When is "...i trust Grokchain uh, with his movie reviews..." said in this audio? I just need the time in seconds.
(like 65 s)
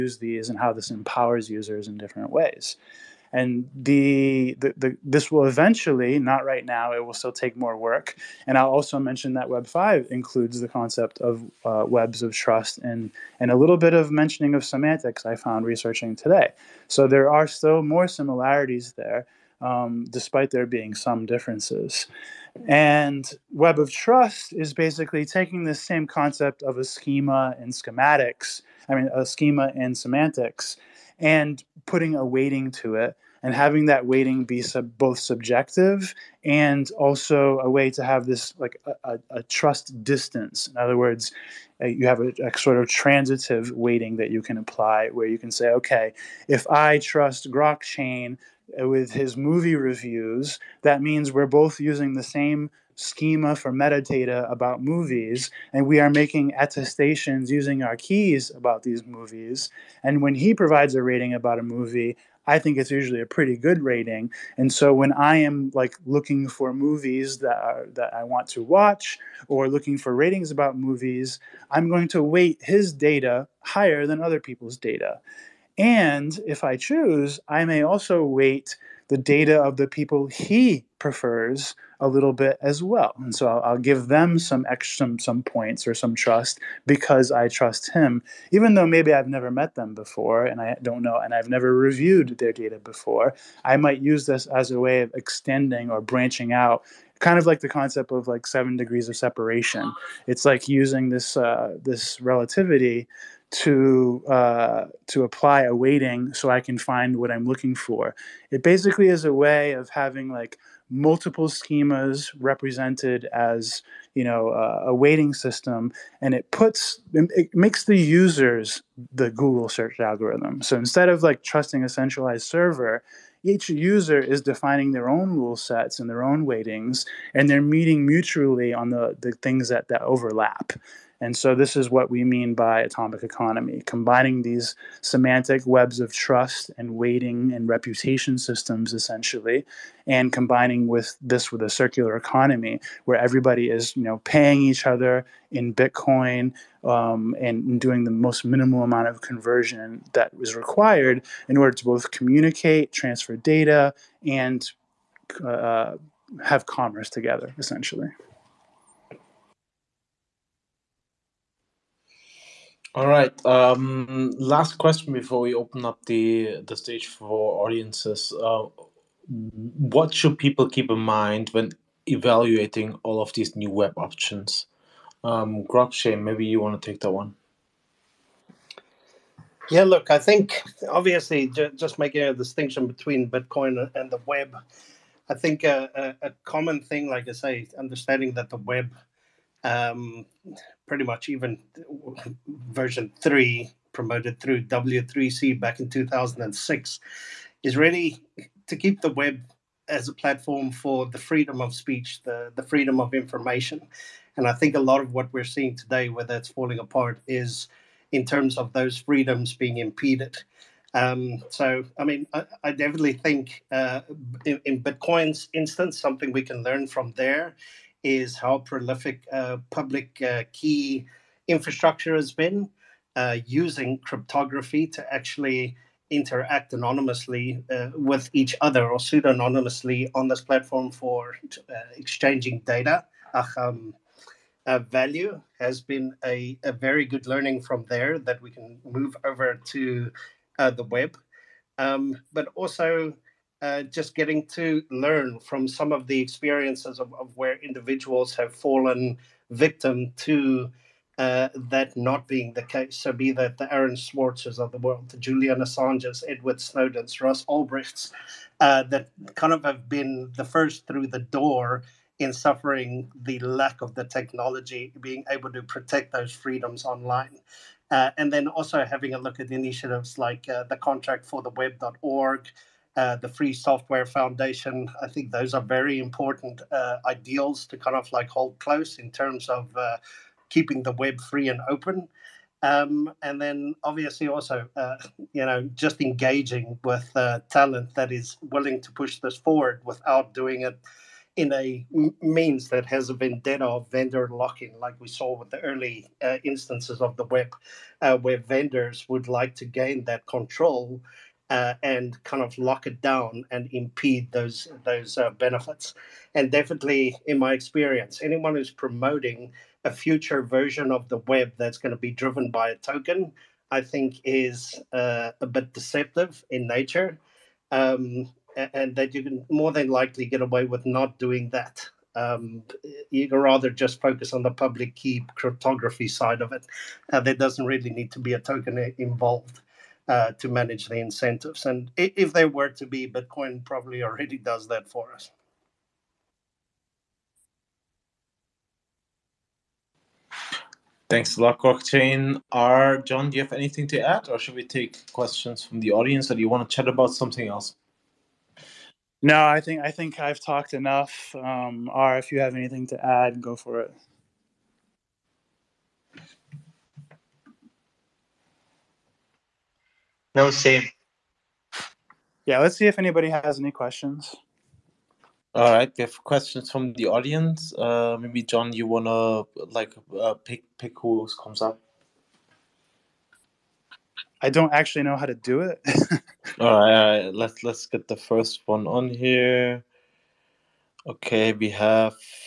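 46 s.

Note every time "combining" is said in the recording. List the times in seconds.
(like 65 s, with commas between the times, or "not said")
133 s, 140 s.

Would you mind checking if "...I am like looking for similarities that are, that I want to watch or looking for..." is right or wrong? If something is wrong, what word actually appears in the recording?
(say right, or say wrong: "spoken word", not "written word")
wrong: "movies", not "similarities".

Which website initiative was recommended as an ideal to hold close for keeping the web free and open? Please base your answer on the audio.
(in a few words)
contract for the web.org.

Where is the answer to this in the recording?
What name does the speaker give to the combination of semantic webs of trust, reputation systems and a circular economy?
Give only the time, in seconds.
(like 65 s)
132 s.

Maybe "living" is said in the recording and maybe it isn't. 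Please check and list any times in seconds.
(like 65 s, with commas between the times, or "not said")
not said.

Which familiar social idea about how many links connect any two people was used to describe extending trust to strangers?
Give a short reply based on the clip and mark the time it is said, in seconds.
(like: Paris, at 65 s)
seven degrees of separation, at 98 s.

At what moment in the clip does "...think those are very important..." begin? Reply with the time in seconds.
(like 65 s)
275 s.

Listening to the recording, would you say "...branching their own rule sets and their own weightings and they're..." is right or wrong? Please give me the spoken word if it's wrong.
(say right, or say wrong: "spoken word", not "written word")
wrong: "defining", not "branching".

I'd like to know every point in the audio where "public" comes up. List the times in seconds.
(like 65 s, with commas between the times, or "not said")
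219 s, 324 s.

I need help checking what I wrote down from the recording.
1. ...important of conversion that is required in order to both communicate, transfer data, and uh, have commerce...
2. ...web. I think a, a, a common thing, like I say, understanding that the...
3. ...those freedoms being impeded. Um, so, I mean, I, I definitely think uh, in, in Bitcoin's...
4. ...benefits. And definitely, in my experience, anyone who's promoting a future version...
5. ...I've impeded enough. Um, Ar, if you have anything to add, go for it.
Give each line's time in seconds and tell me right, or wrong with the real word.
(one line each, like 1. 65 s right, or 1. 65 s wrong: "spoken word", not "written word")
1. 148 s wrong: "amount", not "important"
2. 184 s right
3. 208 s right
4. 305 s right
5. 350 s wrong: "talked", not "impeded".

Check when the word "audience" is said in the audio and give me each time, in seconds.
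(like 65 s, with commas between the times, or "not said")
167 s, 345 s, 367 s.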